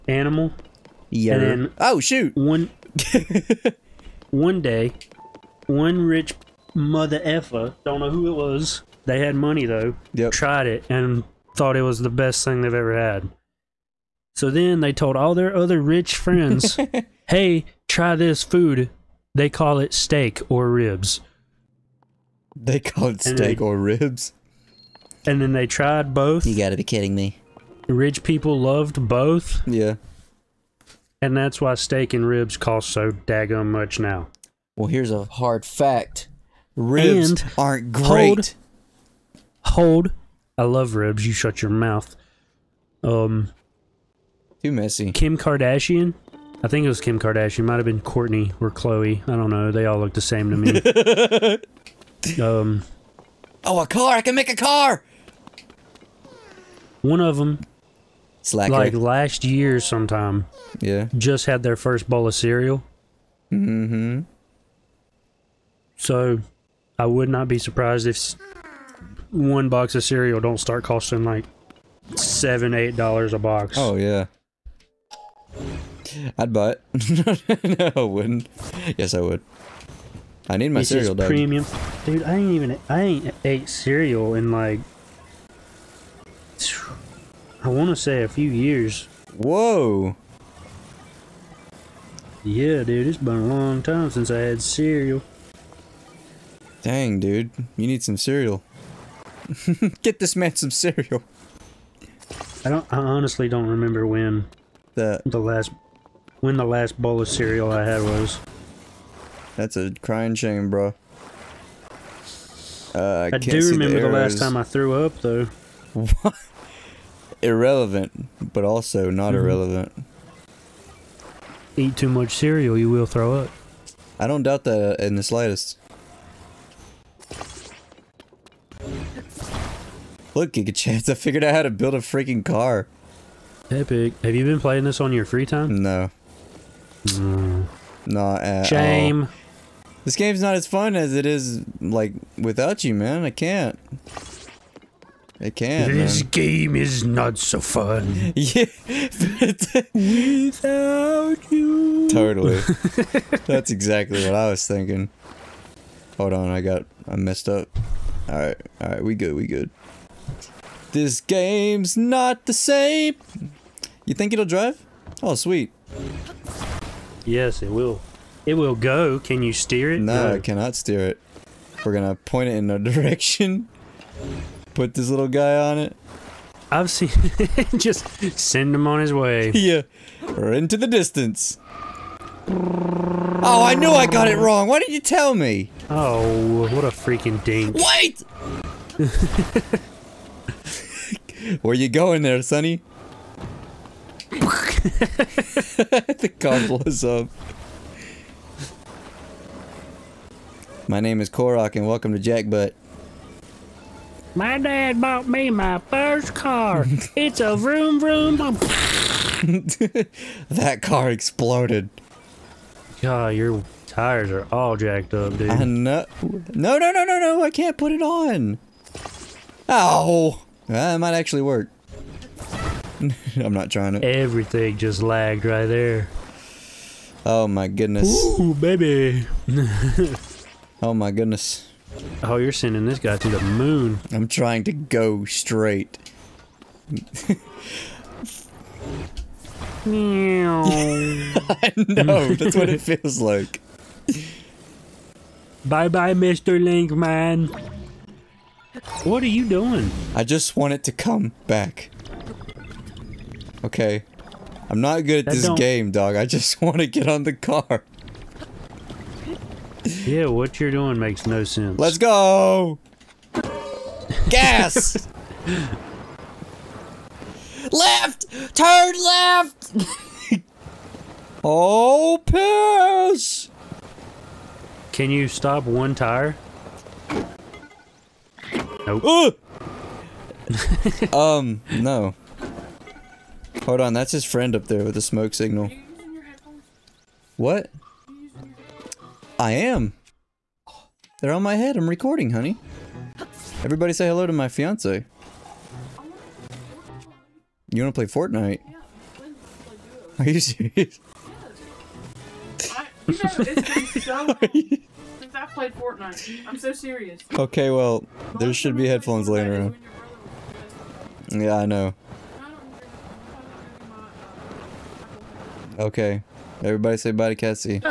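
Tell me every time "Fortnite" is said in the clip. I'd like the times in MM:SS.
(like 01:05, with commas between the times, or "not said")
04:58, 05:05.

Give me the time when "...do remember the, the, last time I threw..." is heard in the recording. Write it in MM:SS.
01:53.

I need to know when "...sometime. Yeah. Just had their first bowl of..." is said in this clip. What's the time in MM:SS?
00:59.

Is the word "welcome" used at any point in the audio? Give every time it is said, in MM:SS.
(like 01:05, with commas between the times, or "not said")
03:21.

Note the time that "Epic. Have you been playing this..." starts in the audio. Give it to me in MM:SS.
02:13.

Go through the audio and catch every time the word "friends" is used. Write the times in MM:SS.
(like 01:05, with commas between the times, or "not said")
00:16, 04:44.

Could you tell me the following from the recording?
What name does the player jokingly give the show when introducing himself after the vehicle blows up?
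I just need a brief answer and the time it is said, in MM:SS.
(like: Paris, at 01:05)
Jackbutt, at 03:22.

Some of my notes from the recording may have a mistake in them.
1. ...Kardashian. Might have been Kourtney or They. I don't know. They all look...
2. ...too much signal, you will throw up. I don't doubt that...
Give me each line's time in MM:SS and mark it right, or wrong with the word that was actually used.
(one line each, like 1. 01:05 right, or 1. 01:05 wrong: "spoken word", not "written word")
1. 00:47 wrong: "Khloé", not "They"
2. 02:01 wrong: "cereal", not "signal".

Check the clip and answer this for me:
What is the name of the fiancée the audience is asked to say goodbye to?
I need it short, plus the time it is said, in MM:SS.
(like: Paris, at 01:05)
Cassie, at 05:17.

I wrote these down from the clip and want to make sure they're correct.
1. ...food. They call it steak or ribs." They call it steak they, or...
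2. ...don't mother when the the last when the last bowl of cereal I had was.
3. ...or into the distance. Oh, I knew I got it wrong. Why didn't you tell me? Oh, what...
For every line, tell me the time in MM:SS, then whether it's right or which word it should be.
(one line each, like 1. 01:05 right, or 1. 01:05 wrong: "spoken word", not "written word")
1. 00:18 right
2. 01:43 wrong: "remember", not "mother"
3. 03:00 right.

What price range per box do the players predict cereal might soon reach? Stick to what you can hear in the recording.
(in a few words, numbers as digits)
7 to 8 dollars.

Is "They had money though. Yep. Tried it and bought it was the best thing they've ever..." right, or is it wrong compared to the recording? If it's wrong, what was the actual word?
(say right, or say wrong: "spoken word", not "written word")
wrong: "thought", not "bought".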